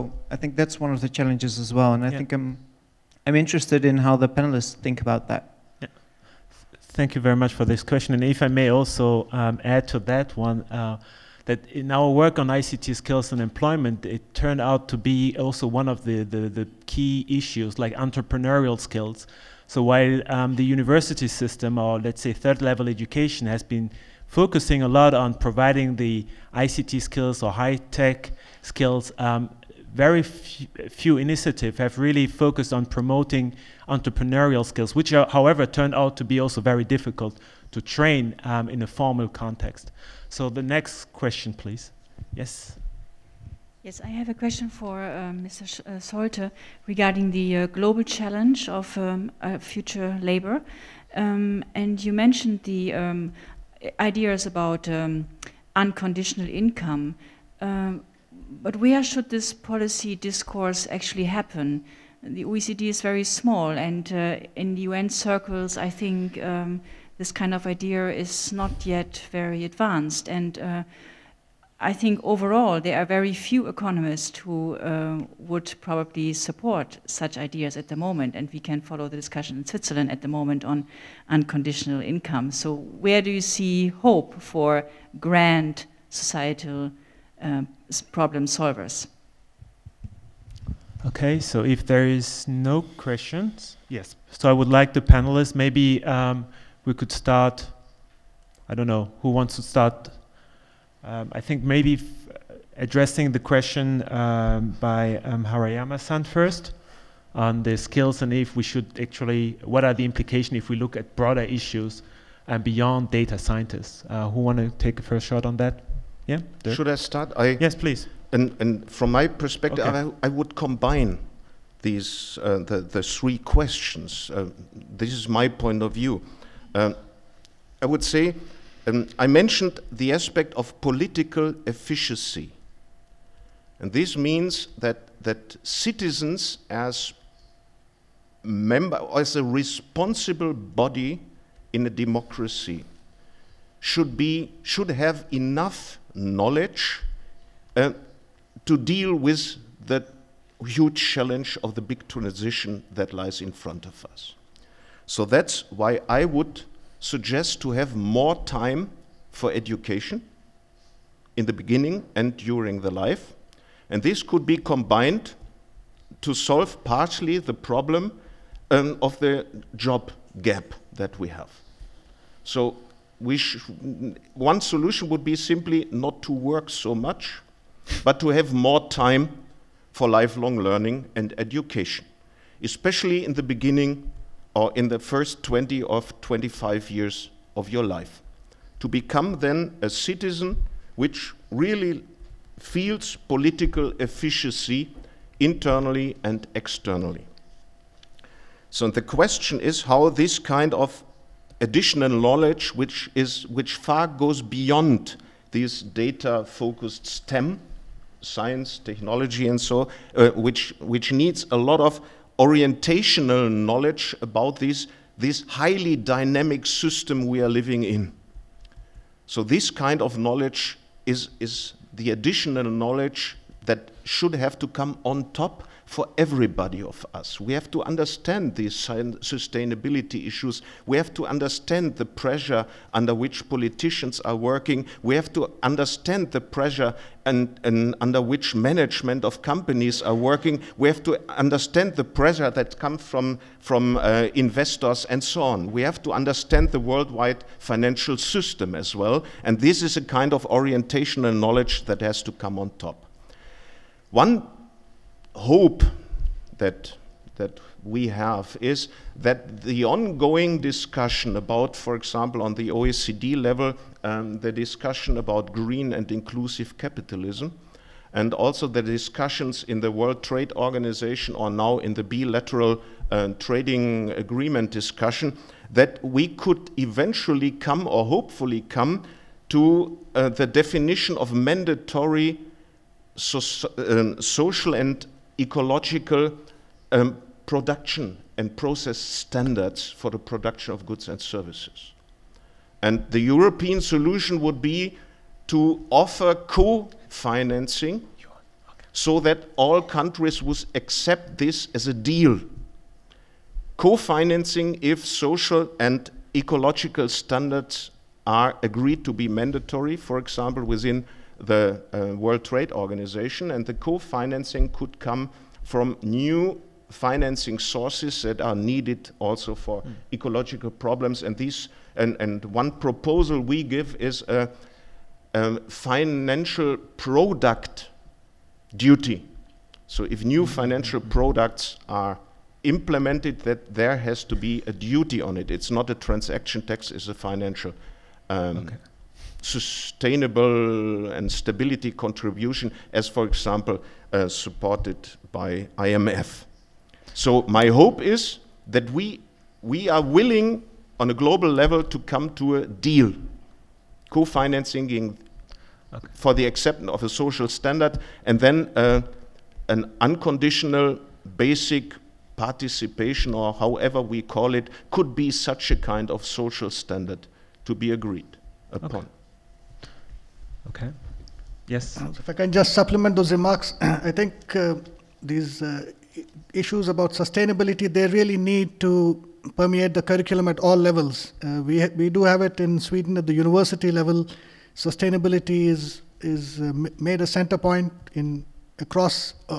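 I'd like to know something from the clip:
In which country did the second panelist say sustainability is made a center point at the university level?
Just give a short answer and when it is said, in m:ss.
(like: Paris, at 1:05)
Sweden, at 6:22.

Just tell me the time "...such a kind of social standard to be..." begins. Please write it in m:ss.
6:05.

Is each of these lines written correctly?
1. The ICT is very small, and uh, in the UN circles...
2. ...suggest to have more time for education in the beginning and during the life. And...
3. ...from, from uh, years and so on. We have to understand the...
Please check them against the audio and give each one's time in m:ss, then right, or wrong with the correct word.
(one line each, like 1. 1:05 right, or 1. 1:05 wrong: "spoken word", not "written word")
1. 1:02 wrong: "OECD", not "ICT"
2. 2:36 right
3. 4:03 wrong: "investors", not "years".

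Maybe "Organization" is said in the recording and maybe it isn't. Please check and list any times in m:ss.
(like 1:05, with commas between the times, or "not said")
4:30, 5:12.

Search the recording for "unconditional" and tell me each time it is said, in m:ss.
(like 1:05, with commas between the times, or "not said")
0:55, 1:21, 6:00.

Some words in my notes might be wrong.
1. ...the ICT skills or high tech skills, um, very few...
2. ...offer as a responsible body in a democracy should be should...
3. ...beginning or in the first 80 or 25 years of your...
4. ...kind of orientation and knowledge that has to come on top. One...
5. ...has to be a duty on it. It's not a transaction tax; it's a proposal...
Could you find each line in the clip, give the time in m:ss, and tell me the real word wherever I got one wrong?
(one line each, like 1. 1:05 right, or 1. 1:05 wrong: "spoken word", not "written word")
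1. 0:25 right
2. 2:18 wrong: "member", not "offer"
3. 3:03 wrong: "20", not "80"
4. 4:10 right
5. 5:33 wrong: "financial", not "proposal".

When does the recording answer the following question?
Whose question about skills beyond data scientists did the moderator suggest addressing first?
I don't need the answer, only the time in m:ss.
1:45.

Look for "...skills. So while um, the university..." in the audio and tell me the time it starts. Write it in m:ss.
0:18.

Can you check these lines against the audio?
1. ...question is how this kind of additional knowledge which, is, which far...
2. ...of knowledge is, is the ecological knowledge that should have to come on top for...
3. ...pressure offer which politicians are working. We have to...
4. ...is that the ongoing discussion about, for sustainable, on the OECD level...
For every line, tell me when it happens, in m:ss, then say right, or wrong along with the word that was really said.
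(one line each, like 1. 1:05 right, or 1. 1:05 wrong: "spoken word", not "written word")
1. 3:19 right
2. 3:39 wrong: "additional", not "ecological"
3. 3:52 wrong: "under", not "offer"
4. 4:18 wrong: "example", not "sustainable".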